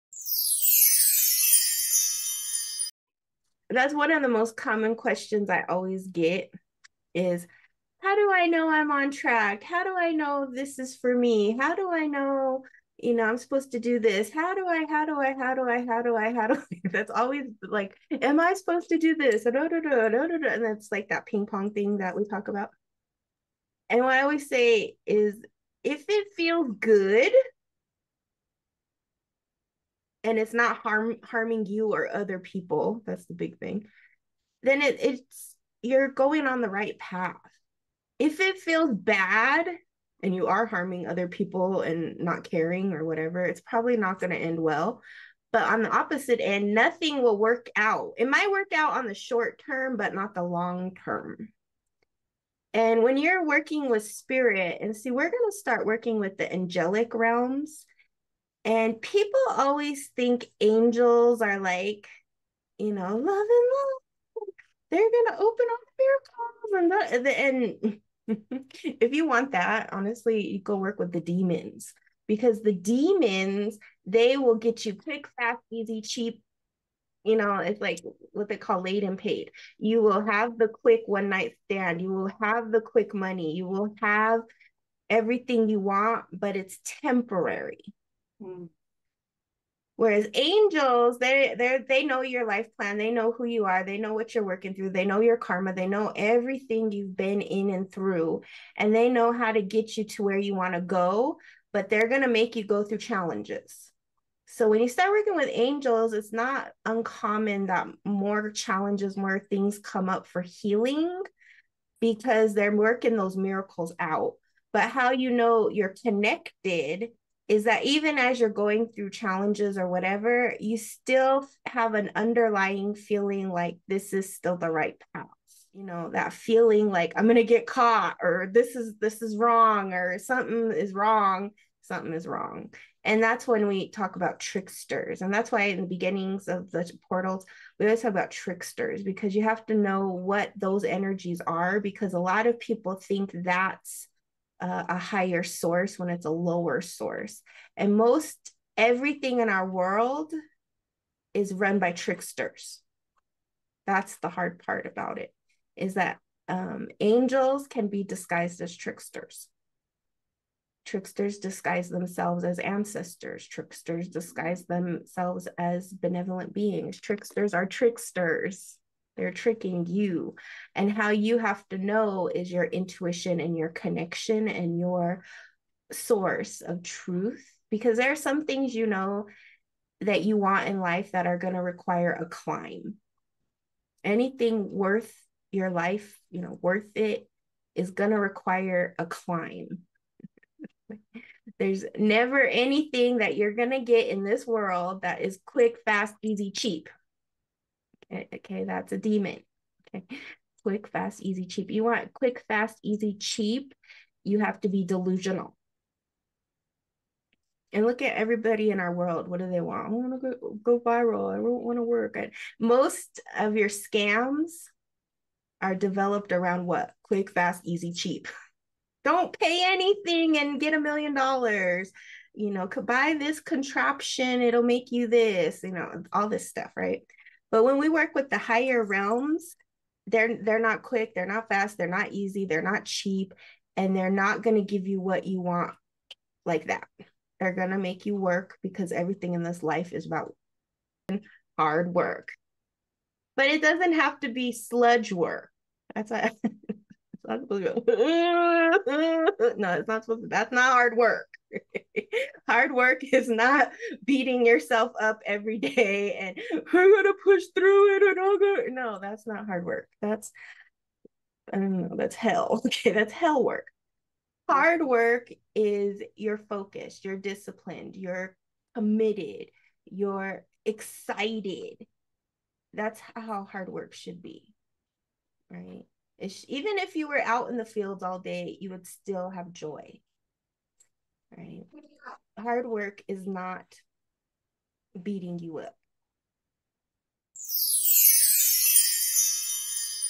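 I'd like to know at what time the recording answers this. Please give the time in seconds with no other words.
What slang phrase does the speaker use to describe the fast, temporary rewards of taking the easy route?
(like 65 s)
78 s.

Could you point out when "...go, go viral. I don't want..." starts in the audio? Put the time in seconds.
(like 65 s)
210 s.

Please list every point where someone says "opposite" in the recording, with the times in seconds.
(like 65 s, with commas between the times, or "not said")
45 s.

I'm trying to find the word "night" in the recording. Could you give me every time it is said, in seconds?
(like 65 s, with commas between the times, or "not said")
81 s.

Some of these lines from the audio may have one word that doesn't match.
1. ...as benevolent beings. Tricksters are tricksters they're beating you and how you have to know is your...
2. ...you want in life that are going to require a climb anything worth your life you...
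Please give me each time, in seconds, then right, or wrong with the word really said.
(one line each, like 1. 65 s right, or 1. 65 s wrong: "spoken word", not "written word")
1. 165 s wrong: "tricking", not "beating"
2. 180 s right.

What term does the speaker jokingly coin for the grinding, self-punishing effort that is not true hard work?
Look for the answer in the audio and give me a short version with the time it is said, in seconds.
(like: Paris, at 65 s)
Hell work, at 263 s.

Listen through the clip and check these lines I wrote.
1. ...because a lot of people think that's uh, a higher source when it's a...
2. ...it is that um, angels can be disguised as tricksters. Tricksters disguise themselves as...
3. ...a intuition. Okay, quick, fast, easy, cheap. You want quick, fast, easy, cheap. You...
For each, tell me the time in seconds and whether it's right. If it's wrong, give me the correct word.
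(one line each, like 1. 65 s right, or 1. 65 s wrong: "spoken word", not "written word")
1. 141 s right
2. 155 s right
3. 198 s wrong: "demon", not "intuition".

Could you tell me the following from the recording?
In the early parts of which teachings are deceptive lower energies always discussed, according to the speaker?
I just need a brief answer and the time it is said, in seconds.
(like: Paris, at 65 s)
The portals, at 136 s.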